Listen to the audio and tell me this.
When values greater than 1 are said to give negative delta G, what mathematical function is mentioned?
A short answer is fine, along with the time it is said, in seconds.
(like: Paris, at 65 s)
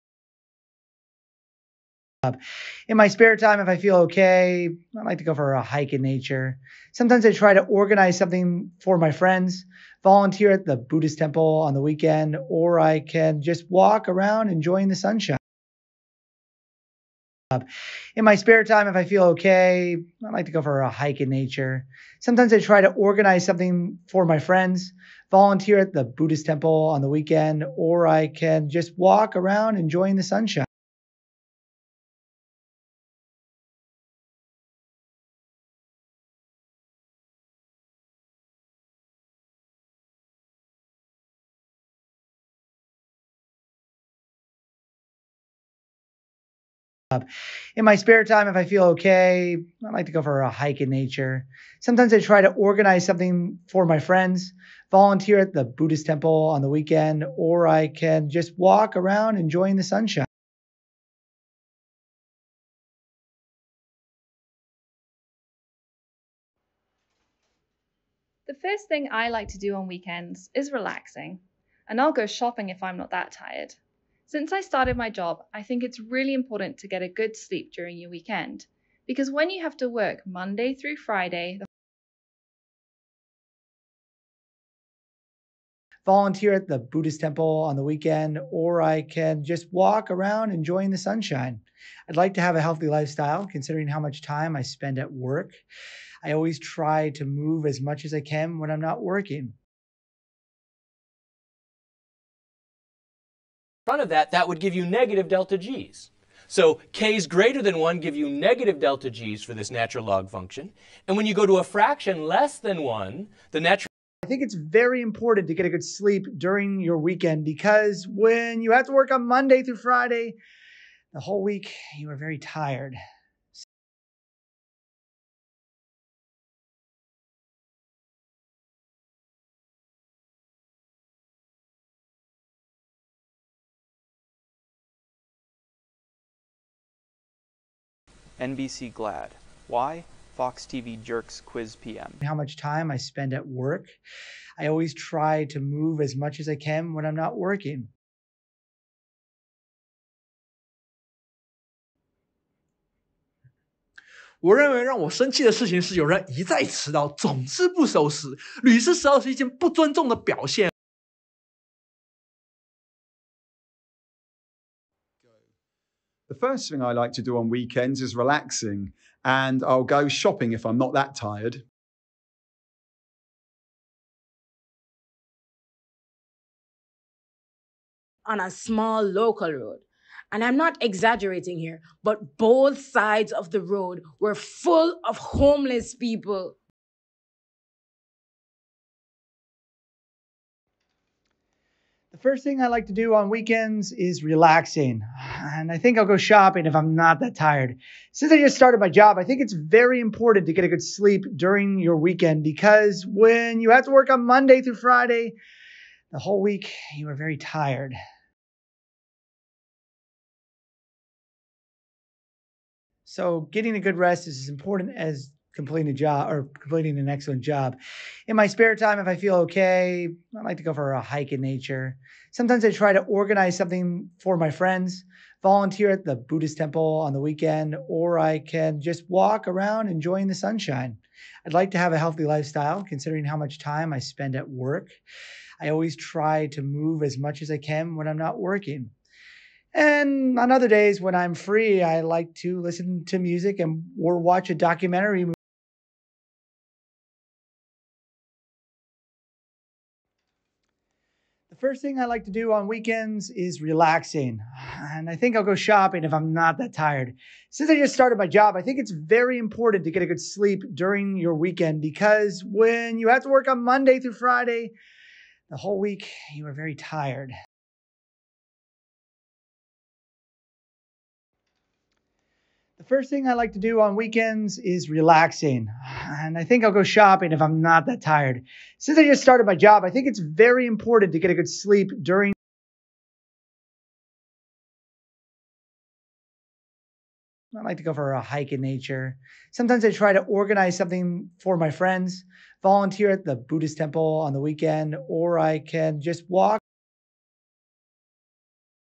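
natural log function, at 109 s.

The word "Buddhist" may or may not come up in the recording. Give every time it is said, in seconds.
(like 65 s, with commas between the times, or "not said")
10 s, 26 s, 55 s, 86 s, 226 s, 293 s.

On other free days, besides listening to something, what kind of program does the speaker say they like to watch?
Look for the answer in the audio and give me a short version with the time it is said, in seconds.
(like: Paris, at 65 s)
a documentary, at 244 s.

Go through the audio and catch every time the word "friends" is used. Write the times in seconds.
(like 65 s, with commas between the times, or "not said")
9 s, 24 s, 53 s, 224 s, 291 s.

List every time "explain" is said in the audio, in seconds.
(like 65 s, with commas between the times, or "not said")
not said.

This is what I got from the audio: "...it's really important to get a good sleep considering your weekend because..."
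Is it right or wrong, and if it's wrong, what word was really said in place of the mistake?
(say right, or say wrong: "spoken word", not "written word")
wrong: "during", not "considering".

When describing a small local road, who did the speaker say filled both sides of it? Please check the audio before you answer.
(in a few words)
homeless people.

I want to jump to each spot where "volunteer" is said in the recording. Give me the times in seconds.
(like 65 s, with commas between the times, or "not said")
10 s, 25 s, 54 s, 86 s, 225 s, 292 s.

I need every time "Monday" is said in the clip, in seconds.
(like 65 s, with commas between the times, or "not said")
80 s, 119 s, 204 s, 263 s.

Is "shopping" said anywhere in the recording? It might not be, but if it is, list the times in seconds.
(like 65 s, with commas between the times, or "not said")
72 s, 170 s, 196 s, 255 s, 276 s.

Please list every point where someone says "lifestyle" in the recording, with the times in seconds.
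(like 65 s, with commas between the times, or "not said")
92 s, 232 s.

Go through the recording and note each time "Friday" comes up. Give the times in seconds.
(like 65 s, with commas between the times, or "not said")
80 s, 119 s, 204 s, 264 s.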